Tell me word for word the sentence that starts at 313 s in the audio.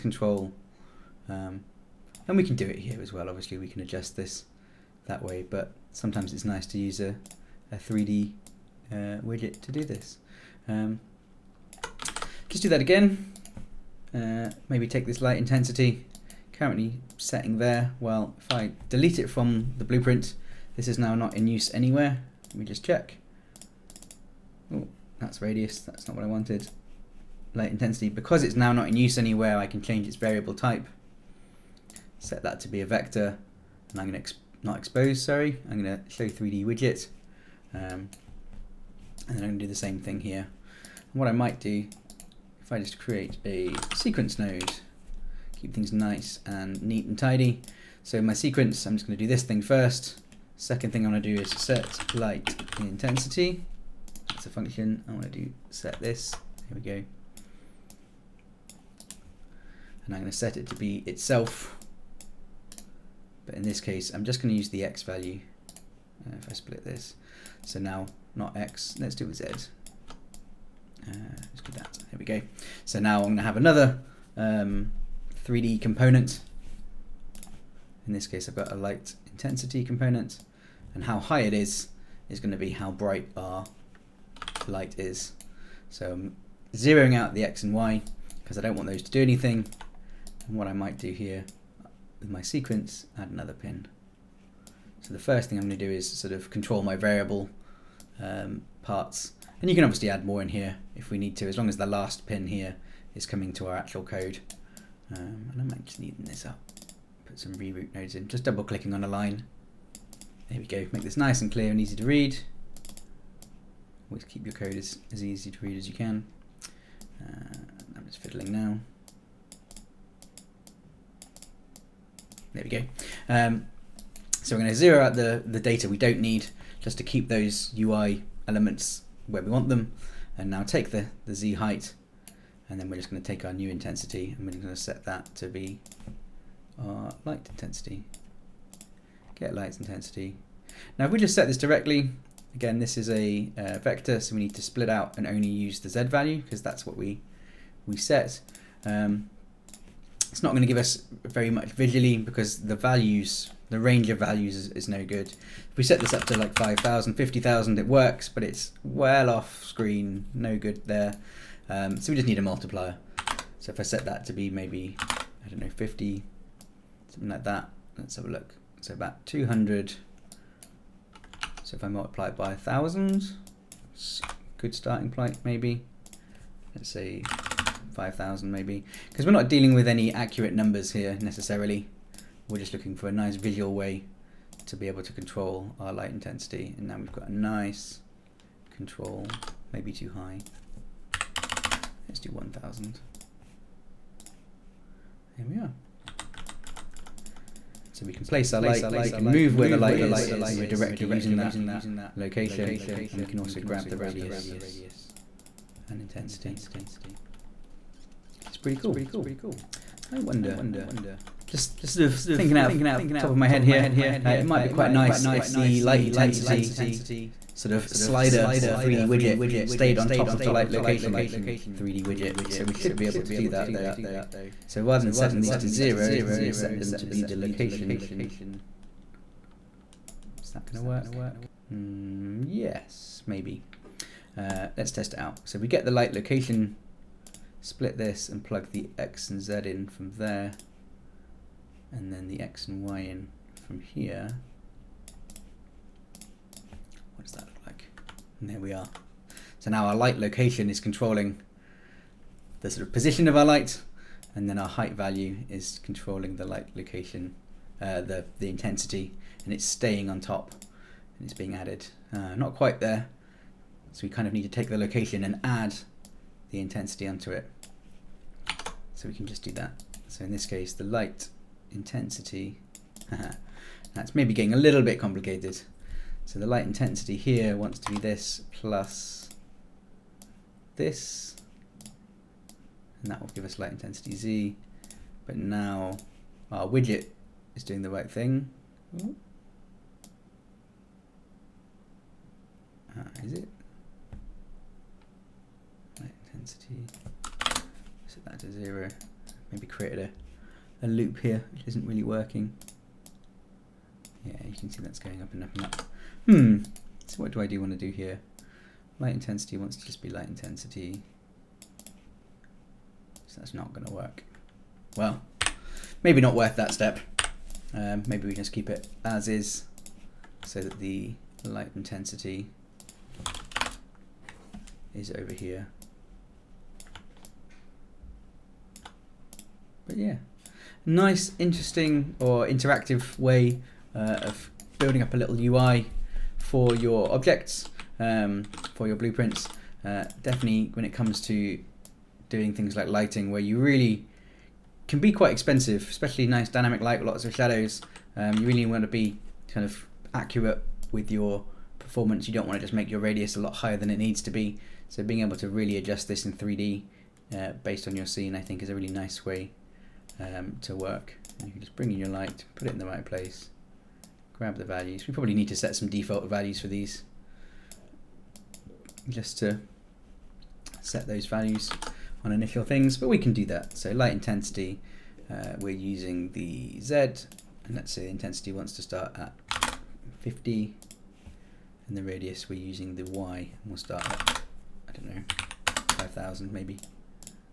So that's not going to work.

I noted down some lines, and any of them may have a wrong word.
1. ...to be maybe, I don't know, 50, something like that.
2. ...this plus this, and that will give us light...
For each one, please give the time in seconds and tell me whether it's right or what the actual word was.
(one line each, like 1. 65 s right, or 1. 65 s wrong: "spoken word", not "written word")
1. 164 s right
2. 277 s right.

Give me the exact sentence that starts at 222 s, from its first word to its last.
So we should be able to do that though.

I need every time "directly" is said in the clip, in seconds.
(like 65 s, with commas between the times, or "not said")
141 s, 200 s.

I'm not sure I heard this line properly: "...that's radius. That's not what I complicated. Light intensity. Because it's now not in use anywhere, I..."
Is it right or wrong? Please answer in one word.
wrong.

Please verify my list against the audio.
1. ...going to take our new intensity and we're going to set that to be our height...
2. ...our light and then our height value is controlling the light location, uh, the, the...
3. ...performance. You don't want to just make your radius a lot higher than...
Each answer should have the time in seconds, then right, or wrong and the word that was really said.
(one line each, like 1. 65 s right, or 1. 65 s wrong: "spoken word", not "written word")
1. 133 s wrong: "light", not "height"
2. 253 s right
3. 351 s right.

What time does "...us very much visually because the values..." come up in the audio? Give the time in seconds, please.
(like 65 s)
150 s.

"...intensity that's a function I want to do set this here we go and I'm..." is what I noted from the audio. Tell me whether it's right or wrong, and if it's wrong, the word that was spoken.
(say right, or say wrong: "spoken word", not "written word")
right.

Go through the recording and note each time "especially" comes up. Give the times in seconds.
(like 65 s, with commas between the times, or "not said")
345 s.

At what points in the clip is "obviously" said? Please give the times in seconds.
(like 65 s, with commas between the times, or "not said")
3 s, 99 s.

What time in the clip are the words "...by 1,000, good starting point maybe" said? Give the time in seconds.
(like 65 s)
172 s.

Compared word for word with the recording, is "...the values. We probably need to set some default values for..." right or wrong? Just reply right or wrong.
right.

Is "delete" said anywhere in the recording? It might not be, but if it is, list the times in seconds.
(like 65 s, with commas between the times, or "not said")
18 s.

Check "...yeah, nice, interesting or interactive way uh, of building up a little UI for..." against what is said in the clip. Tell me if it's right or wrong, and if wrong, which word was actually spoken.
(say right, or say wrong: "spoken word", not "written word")
right.